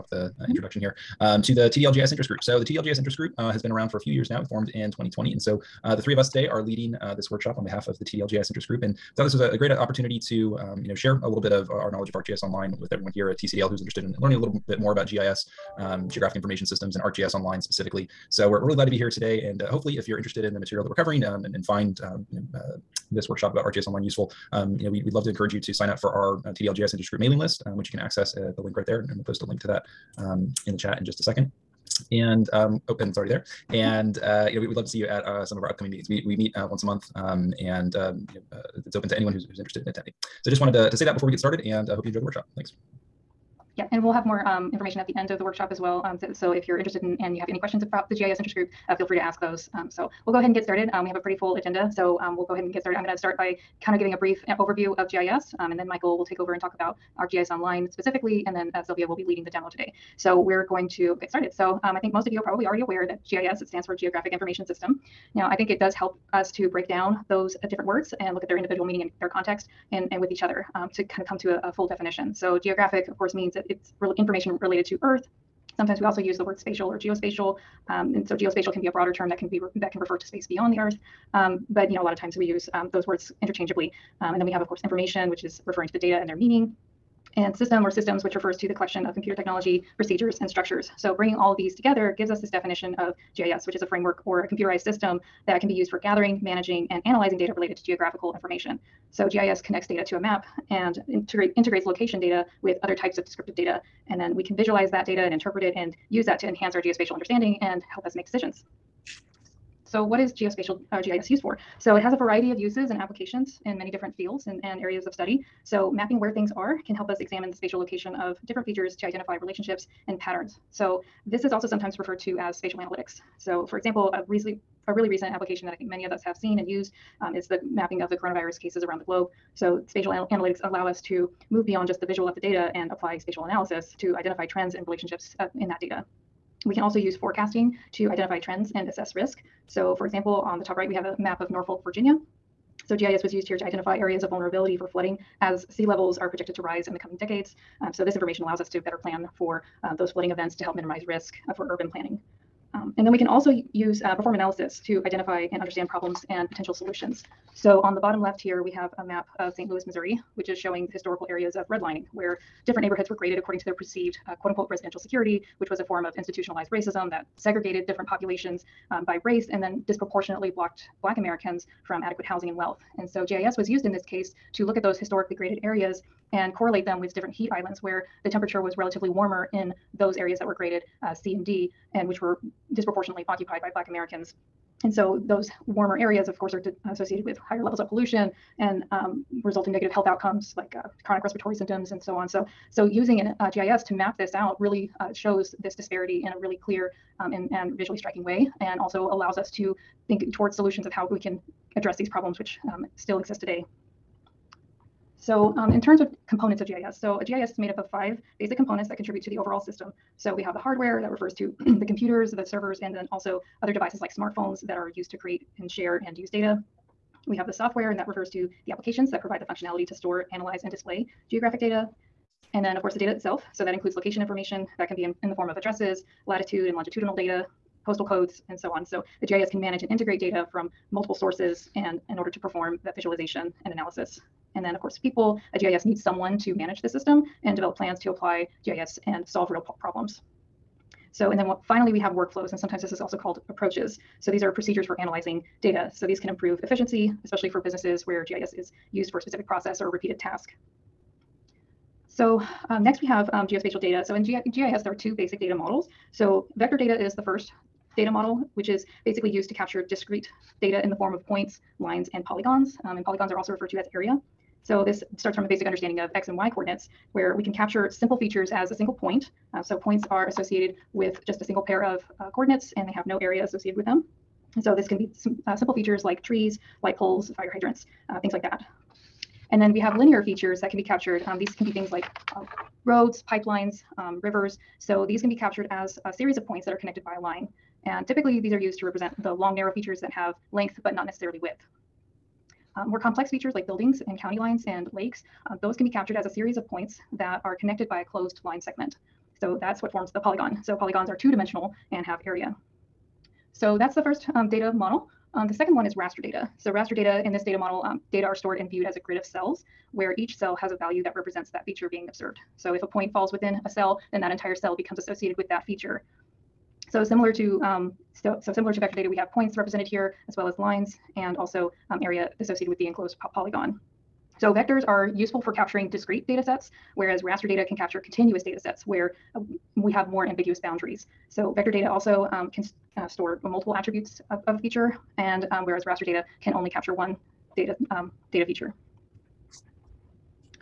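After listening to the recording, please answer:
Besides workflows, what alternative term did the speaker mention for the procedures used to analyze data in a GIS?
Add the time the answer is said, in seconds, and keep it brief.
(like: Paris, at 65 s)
approaches, at 243 s.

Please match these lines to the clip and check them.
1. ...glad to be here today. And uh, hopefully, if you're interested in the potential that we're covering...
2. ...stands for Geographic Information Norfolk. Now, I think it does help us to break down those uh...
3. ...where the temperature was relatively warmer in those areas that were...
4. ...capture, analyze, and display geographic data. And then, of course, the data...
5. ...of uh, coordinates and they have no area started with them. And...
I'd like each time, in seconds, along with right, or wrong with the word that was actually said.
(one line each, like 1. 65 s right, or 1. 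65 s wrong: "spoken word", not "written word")
1. 18 s wrong: "material", not "potential"
2. 63 s wrong: "System", not "Norfolk"
3. 177 s right
4. 219 s wrong: "store", not "capture"
5. 271 s wrong: "associated", not "started".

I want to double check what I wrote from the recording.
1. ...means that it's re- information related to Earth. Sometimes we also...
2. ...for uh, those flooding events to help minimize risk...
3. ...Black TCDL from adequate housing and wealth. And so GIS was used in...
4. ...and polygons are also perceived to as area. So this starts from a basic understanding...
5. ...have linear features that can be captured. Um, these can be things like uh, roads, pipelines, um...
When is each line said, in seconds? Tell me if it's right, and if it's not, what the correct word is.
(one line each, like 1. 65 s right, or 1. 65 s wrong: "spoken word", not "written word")
1. 73 s right
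2. 149 s right
3. 171 s wrong: "Americans", not "TCDL"
4. 262 s wrong: "referred", not "perceived"
5. 279 s right.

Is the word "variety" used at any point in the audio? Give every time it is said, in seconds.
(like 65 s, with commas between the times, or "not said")
112 s.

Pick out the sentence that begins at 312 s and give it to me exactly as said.
So if a point falls within a cell, then that entire cell becomes associated with that feature.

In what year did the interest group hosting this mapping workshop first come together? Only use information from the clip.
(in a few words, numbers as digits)
2020.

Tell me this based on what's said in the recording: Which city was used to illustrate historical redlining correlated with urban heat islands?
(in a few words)
St. Louis, Missouri.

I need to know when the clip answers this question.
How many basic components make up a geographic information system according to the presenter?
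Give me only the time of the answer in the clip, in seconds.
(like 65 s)
207 s.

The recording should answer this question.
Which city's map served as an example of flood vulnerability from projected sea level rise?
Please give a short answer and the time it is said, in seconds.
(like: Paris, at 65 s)
Norfolk, Virginia, at 141 s.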